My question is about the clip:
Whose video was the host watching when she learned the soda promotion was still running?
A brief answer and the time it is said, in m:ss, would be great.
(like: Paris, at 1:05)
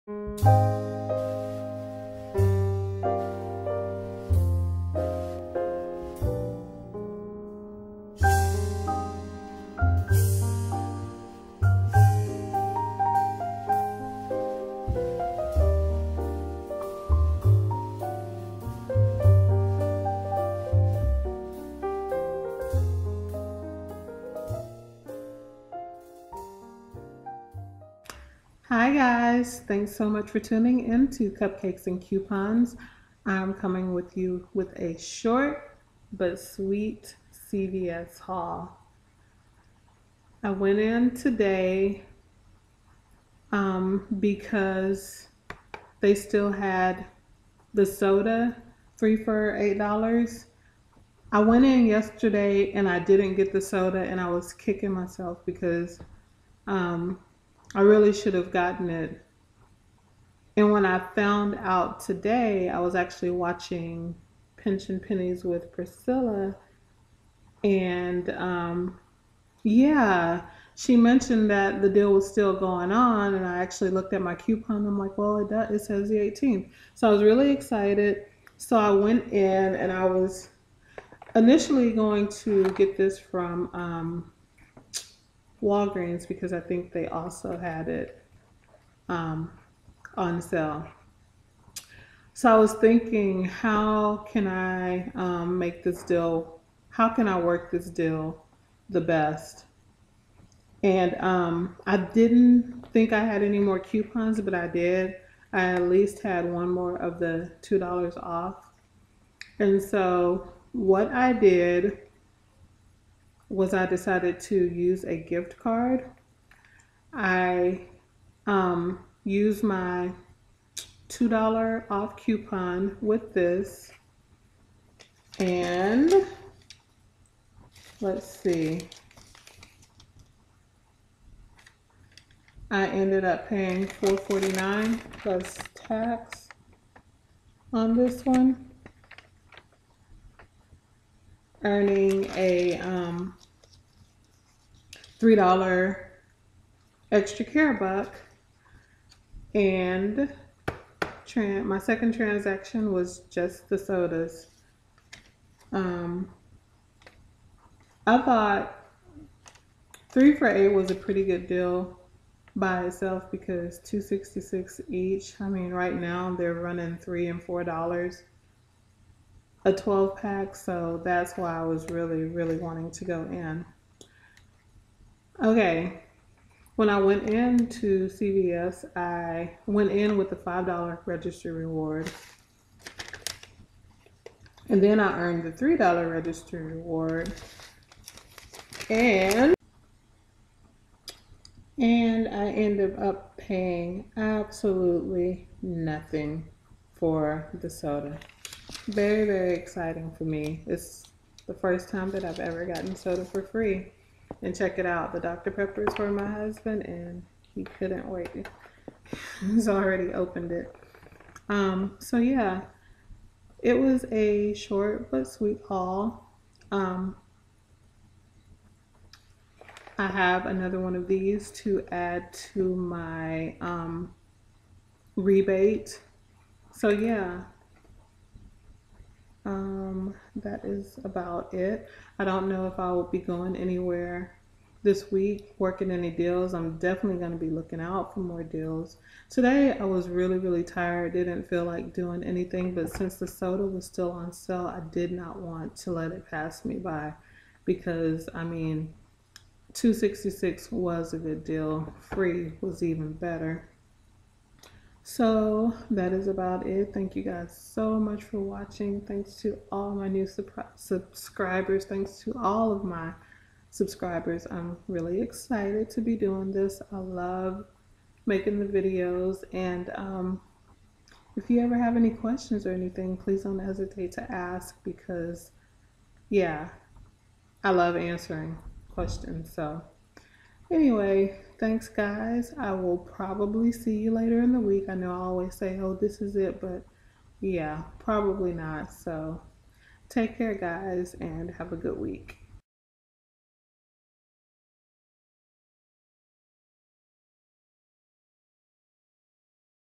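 Pension Pennies with Priscilla, at 1:04.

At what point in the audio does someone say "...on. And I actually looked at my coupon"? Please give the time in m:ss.
1:12.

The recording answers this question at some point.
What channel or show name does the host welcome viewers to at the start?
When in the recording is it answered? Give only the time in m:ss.
0:31.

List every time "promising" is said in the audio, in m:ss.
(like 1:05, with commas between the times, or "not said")
not said.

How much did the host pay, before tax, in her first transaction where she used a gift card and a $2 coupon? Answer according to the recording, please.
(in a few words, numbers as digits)
$4.49.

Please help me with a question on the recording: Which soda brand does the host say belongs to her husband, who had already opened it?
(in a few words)
Dr. Pepper.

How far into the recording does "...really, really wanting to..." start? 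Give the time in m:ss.
2:51.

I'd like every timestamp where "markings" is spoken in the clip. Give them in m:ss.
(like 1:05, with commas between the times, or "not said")
not said.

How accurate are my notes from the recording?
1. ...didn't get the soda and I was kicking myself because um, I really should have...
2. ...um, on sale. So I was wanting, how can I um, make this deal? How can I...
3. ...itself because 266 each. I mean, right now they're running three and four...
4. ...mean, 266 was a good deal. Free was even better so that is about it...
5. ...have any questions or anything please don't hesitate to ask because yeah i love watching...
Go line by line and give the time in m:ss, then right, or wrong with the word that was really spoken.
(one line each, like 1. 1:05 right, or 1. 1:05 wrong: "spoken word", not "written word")
1. 0:52 right
2. 1:29 wrong: "thinking", not "wanting"
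3. 2:42 right
4. 4:08 right
5. 4:31 wrong: "answering", not "watching".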